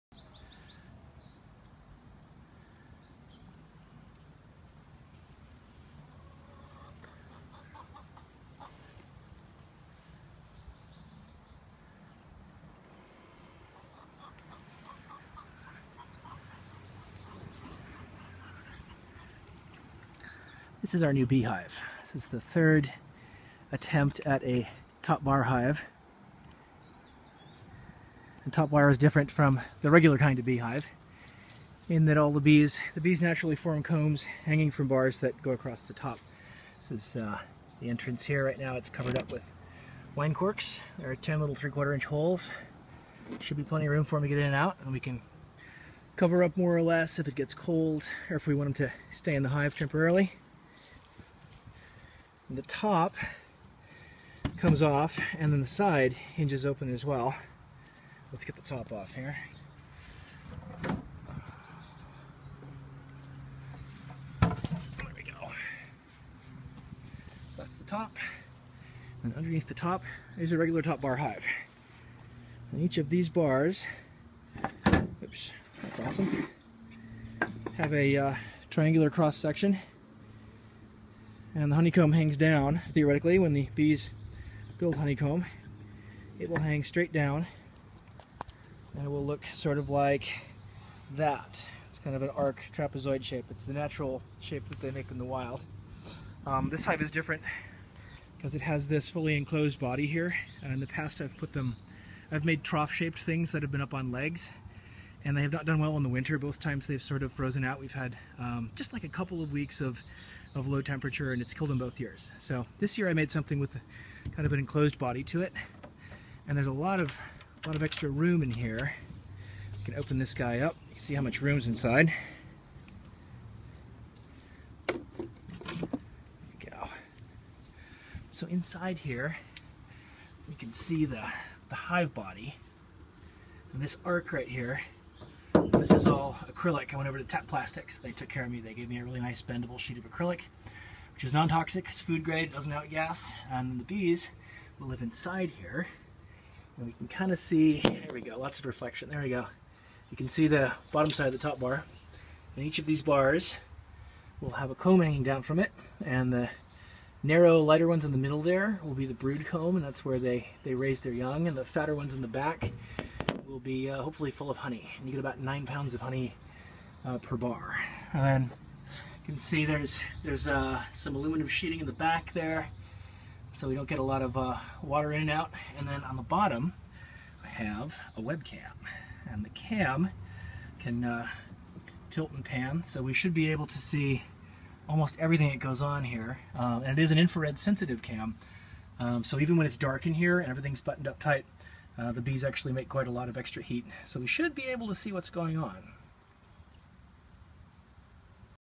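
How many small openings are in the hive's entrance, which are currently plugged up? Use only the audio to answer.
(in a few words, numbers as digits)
10.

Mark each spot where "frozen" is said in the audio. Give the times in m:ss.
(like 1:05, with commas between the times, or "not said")
1:47.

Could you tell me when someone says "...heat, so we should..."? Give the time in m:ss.
3:13.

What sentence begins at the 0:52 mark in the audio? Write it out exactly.
And the top comes off and then the side hinges open as well.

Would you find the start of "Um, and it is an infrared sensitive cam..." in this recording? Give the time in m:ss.
3:06.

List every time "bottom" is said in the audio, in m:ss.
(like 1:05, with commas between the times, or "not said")
2:30, 2:56.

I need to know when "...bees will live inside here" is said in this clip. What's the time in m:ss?
2:23.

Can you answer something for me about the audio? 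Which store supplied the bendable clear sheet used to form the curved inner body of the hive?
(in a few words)
Tap Plastics.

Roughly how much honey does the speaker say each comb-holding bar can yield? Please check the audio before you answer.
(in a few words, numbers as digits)
9 pounds.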